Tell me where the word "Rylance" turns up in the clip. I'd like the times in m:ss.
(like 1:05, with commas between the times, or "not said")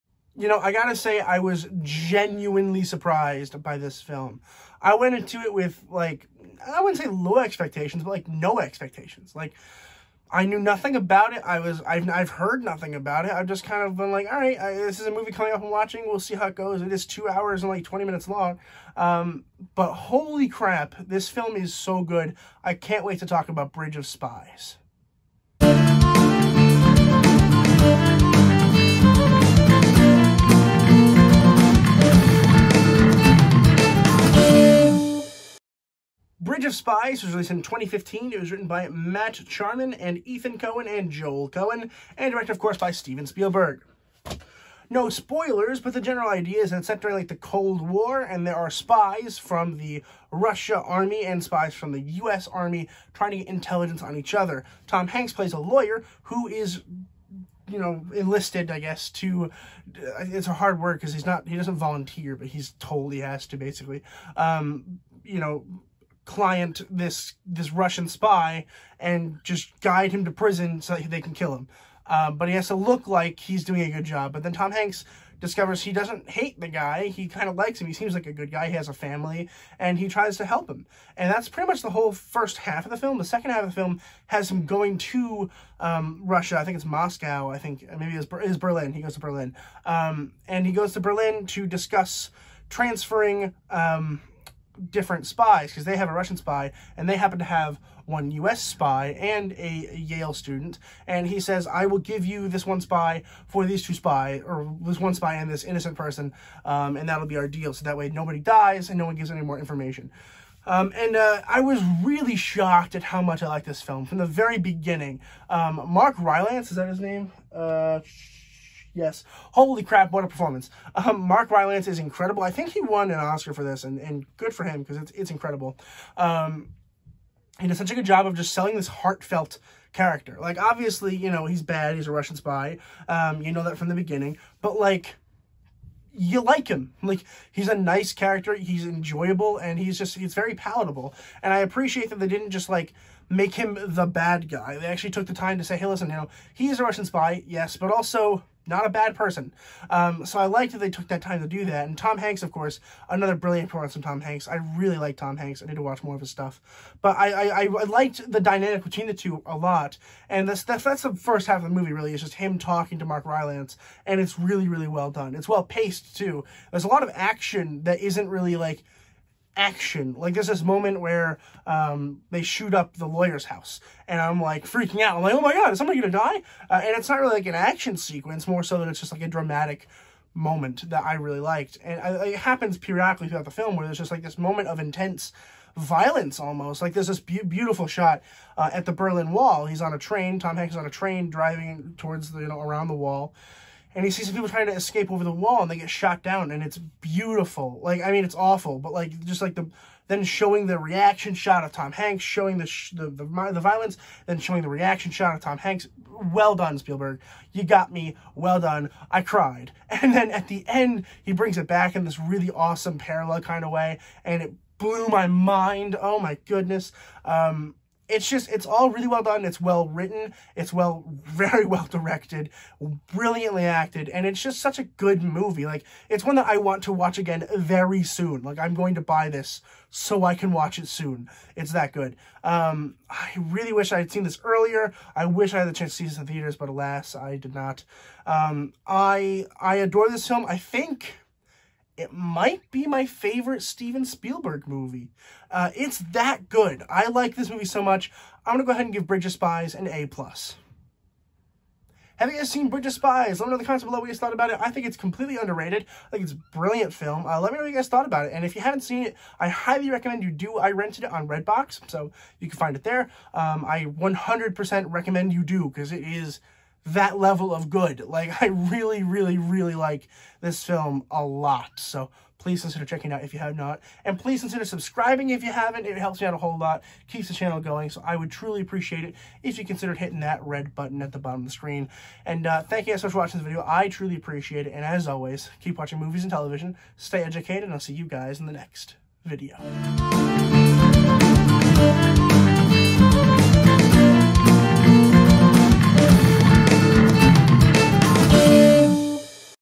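1:56, 2:01, 2:43.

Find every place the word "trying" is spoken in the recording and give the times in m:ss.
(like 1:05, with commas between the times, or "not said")
0:53, 3:14.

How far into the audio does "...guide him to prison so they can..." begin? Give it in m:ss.
1:09.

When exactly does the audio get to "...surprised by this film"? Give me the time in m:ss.
0:02.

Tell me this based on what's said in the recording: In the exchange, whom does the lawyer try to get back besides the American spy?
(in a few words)
A Yale student.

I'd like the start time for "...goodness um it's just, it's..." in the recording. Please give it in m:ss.
3:36.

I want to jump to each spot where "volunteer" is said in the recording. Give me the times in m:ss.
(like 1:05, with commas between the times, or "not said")
1:01.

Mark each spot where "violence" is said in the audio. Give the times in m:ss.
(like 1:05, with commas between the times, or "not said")
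3:05, 3:23.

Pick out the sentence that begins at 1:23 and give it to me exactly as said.
The second half of the film has him going to um, Russia.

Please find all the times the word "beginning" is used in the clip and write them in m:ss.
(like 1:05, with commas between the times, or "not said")
1:54, 2:13.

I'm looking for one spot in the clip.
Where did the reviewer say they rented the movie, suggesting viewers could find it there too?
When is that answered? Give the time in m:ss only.
4:21.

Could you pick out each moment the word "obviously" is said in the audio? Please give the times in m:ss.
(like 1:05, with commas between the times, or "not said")
2:10.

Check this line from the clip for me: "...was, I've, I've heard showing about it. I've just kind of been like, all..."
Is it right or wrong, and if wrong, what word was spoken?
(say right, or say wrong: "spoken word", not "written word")
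wrong: "nothing", not "showing".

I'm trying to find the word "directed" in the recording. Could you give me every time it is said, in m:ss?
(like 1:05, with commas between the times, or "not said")
0:42, 3:41.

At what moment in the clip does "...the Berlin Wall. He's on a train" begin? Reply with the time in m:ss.
3:08.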